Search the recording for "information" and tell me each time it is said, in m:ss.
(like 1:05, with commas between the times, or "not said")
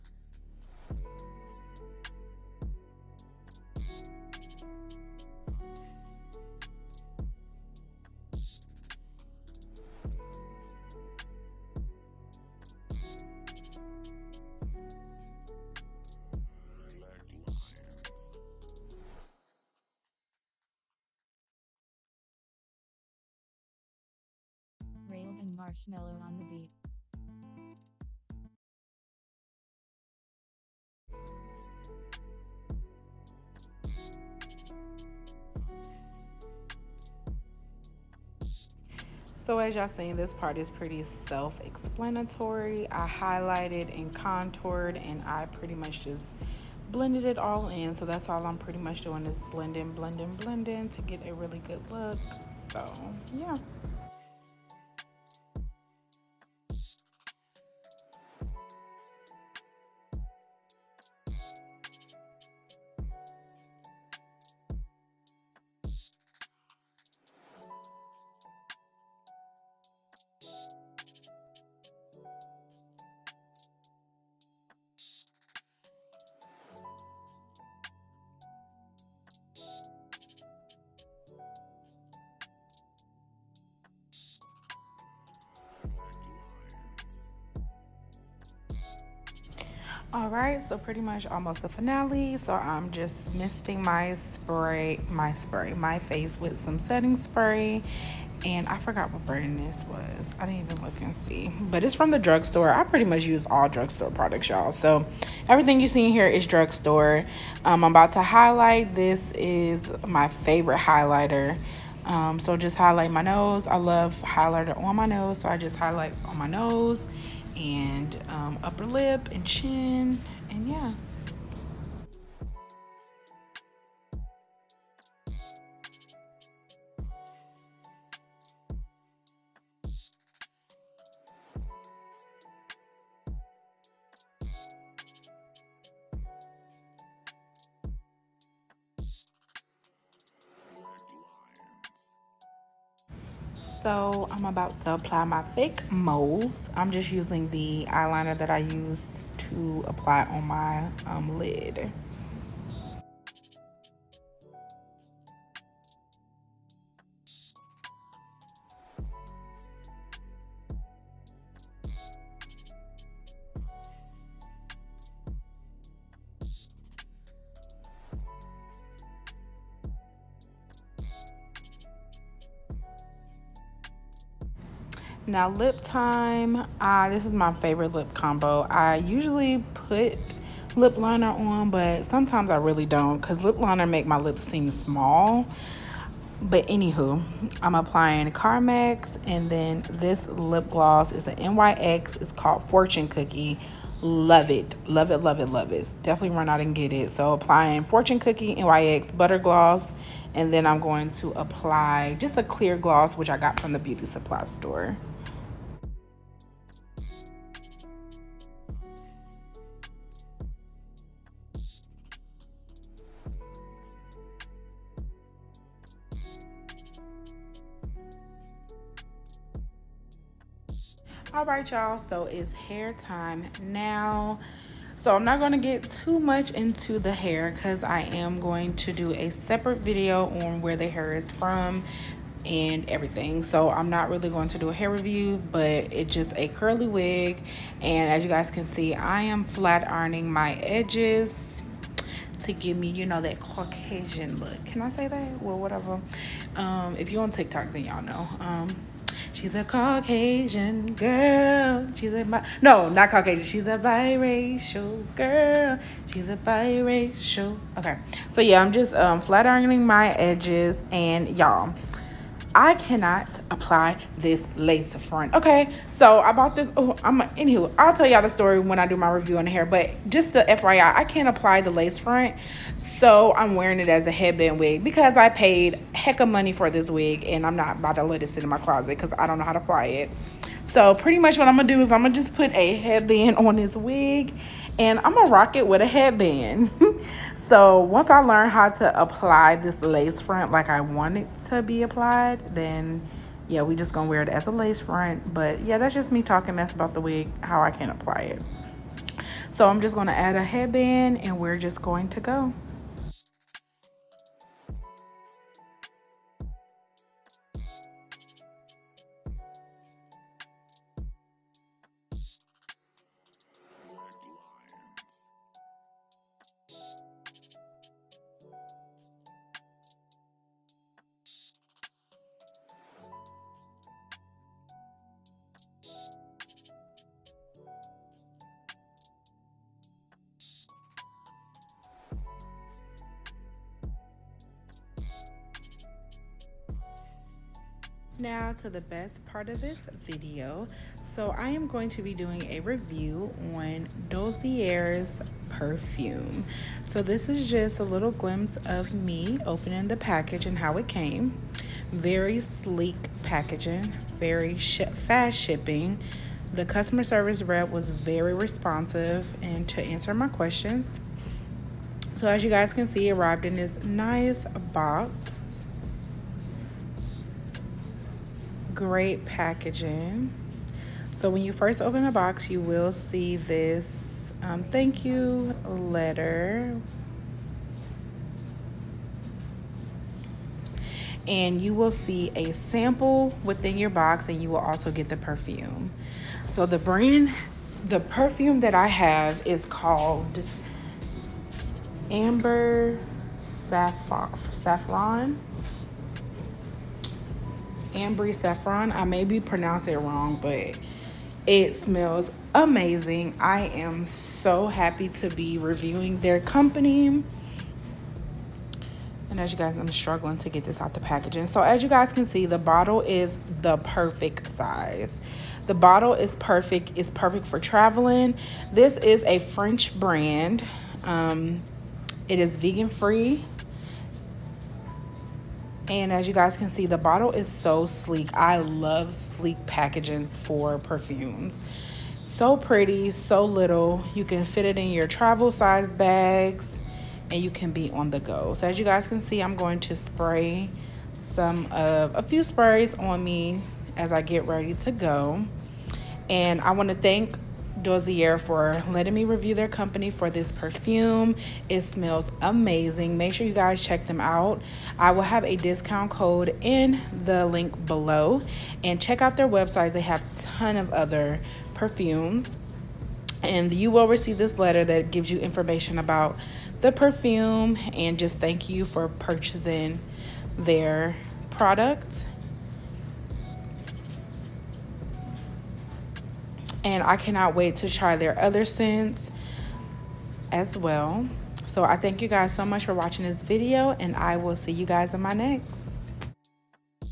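7:45.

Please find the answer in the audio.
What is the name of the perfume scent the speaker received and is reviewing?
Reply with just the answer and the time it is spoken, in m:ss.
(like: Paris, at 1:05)
Ambery Saffron, at 6:37.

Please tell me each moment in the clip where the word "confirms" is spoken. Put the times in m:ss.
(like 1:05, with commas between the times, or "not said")
not said.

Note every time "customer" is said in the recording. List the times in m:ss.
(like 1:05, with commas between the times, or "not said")
5:56.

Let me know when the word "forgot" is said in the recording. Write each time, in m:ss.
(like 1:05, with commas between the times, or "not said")
1:38.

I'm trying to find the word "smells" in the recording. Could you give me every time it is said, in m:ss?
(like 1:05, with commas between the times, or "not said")
6:41, 7:31.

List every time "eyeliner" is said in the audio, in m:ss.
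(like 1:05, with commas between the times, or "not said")
2:27.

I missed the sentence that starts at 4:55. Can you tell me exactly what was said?
But yeah, that's just me talking mess about the wig, how I can apply it.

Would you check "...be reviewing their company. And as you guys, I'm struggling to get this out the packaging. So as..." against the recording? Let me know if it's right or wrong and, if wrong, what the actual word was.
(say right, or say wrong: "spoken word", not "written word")
right.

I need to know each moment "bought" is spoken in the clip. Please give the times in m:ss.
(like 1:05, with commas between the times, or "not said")
4:26.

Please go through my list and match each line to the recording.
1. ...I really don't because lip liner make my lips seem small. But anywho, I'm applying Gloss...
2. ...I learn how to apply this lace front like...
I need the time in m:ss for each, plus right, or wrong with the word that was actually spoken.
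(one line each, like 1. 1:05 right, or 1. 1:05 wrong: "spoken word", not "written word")
1. 3:02 wrong: "Carmex", not "Gloss"
2. 4:48 right.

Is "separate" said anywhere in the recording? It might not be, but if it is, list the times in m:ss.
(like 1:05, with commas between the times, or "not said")
3:49.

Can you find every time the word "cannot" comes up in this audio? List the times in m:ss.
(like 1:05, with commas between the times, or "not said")
4:22, 7:57.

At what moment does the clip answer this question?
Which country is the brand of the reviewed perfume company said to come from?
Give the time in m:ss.
6:59.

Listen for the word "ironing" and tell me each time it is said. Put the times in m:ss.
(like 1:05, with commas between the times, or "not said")
3:59, 4:19.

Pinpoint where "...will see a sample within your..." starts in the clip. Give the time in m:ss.
6:21.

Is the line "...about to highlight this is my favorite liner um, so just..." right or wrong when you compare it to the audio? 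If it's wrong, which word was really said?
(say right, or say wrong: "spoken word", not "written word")
wrong: "highlighter", not "liner".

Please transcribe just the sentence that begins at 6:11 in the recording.
So when you first open the box, you will see this um, thank you letter.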